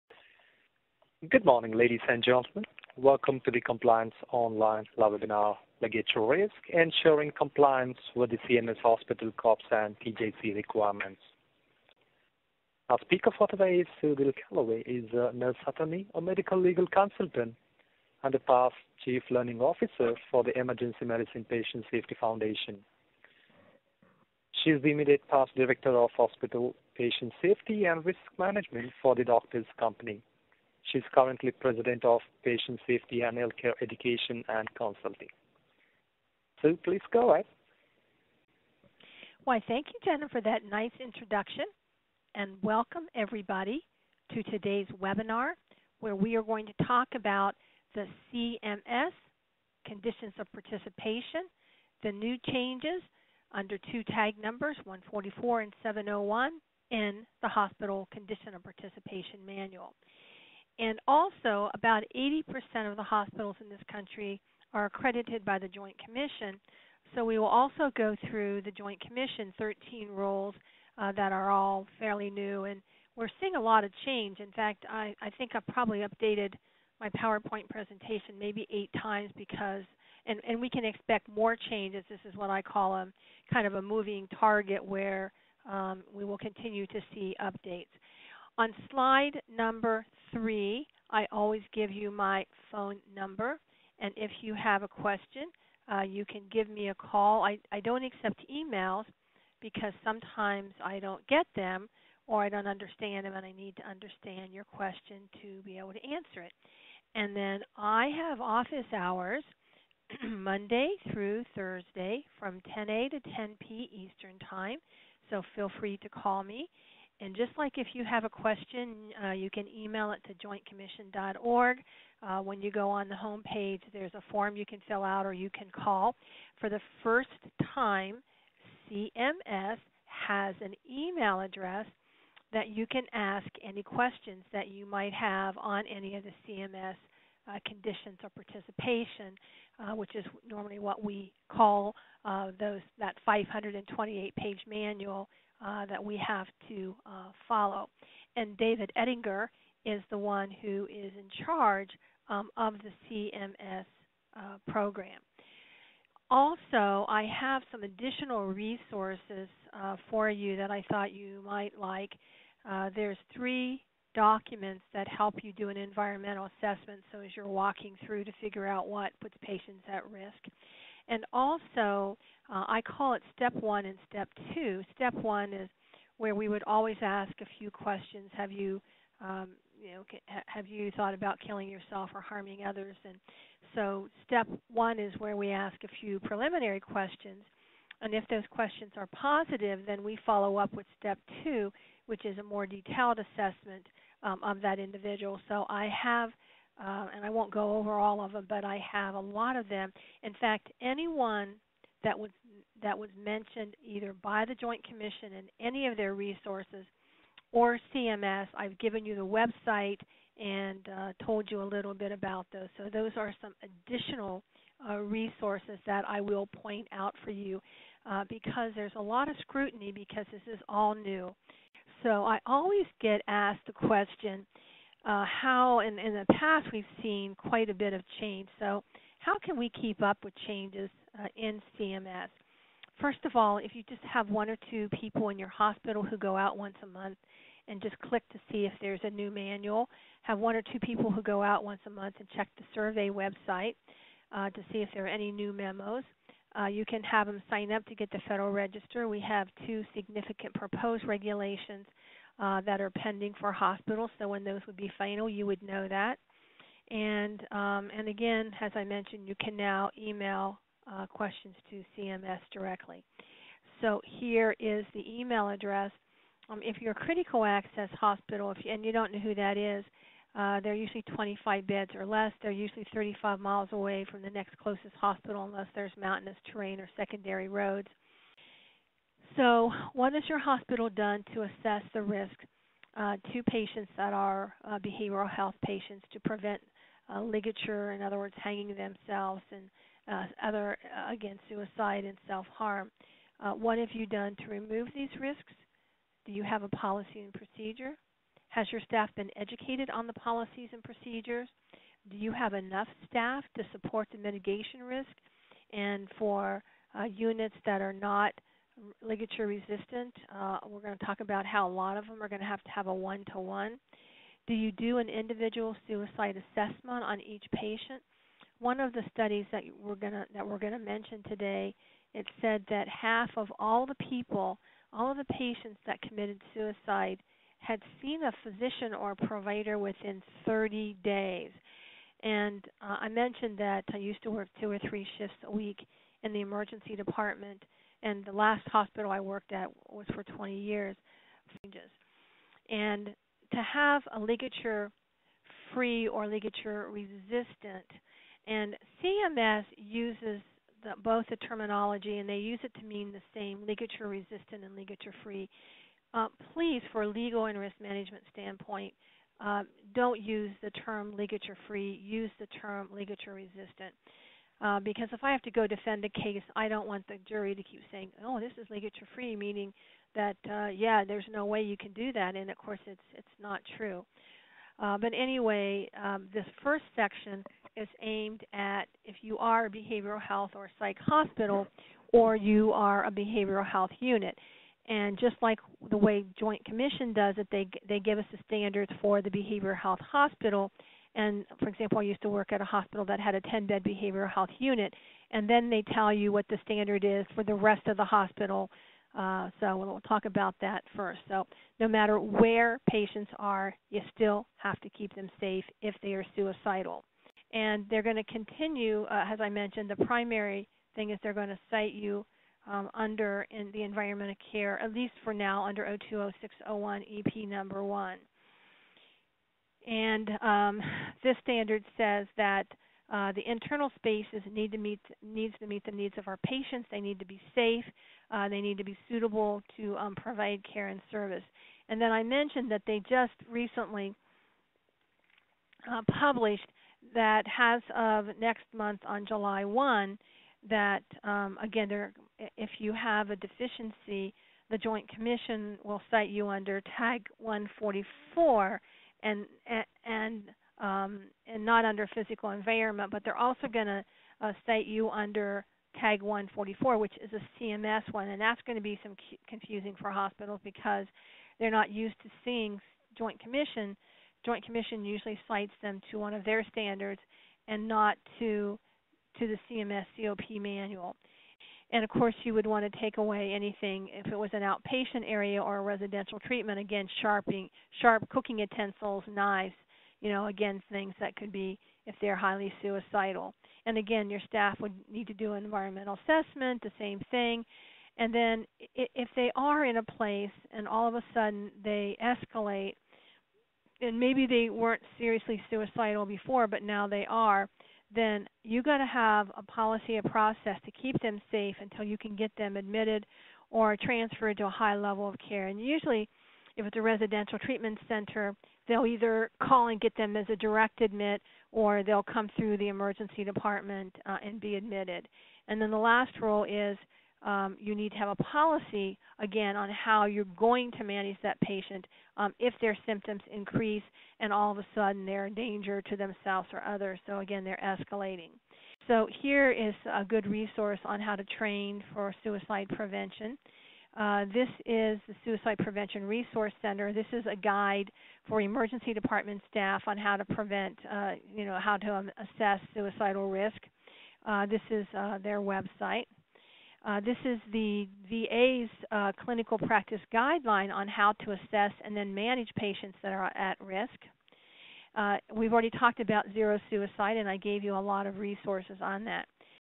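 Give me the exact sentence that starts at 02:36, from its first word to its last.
Also, I have some additional resources uh, for you that I thought you might like.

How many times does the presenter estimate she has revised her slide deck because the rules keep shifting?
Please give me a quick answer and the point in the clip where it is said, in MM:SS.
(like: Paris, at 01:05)
8, at 01:18.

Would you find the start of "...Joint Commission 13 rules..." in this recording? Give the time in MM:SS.
01:08.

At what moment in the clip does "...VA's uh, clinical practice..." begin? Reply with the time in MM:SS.
09:08.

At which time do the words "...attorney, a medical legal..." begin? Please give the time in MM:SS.
00:15.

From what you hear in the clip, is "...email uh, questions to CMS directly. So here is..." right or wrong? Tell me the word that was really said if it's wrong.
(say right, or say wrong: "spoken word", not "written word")
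right.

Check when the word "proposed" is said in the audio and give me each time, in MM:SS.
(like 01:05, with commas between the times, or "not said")
04:10.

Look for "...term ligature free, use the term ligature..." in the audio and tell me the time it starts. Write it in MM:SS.
06:00.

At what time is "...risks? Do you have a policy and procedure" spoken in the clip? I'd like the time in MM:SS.
04:55.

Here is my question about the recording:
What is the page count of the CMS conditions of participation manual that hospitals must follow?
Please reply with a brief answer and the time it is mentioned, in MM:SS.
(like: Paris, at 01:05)
528, at 02:23.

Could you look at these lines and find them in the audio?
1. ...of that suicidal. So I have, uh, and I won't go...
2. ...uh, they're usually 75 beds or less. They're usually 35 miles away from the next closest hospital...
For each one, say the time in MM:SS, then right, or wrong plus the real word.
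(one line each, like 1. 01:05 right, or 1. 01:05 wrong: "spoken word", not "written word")
1. 03:14 wrong: "individual", not "suicidal"
2. 04:30 wrong: "25", not "75".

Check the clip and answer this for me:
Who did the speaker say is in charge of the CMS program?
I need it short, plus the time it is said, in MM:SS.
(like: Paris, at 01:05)
David Ettinger, at 02:28.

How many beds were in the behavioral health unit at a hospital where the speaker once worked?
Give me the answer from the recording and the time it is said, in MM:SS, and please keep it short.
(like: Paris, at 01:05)
10, at 06:33.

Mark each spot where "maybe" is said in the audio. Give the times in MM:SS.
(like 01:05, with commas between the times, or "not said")
01:18, 08:14.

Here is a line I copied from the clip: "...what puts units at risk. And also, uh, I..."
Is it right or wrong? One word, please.
wrong.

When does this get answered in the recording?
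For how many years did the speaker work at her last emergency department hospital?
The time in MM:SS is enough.
05:40.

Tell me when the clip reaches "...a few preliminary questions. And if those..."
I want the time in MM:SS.
03:05.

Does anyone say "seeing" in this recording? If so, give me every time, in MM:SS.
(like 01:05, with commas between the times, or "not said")
01:13, 07:42.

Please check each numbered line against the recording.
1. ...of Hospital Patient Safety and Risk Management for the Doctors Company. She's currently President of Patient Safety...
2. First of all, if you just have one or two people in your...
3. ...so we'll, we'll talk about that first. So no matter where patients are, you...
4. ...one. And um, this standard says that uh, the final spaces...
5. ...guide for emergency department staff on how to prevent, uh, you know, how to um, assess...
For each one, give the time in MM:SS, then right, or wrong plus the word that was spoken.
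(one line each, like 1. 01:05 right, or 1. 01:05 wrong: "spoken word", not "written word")
1. 00:25 right
2. 03:52 right
3. 06:39 right
4. 06:57 wrong: "internal", not "final"
5. 08:57 right.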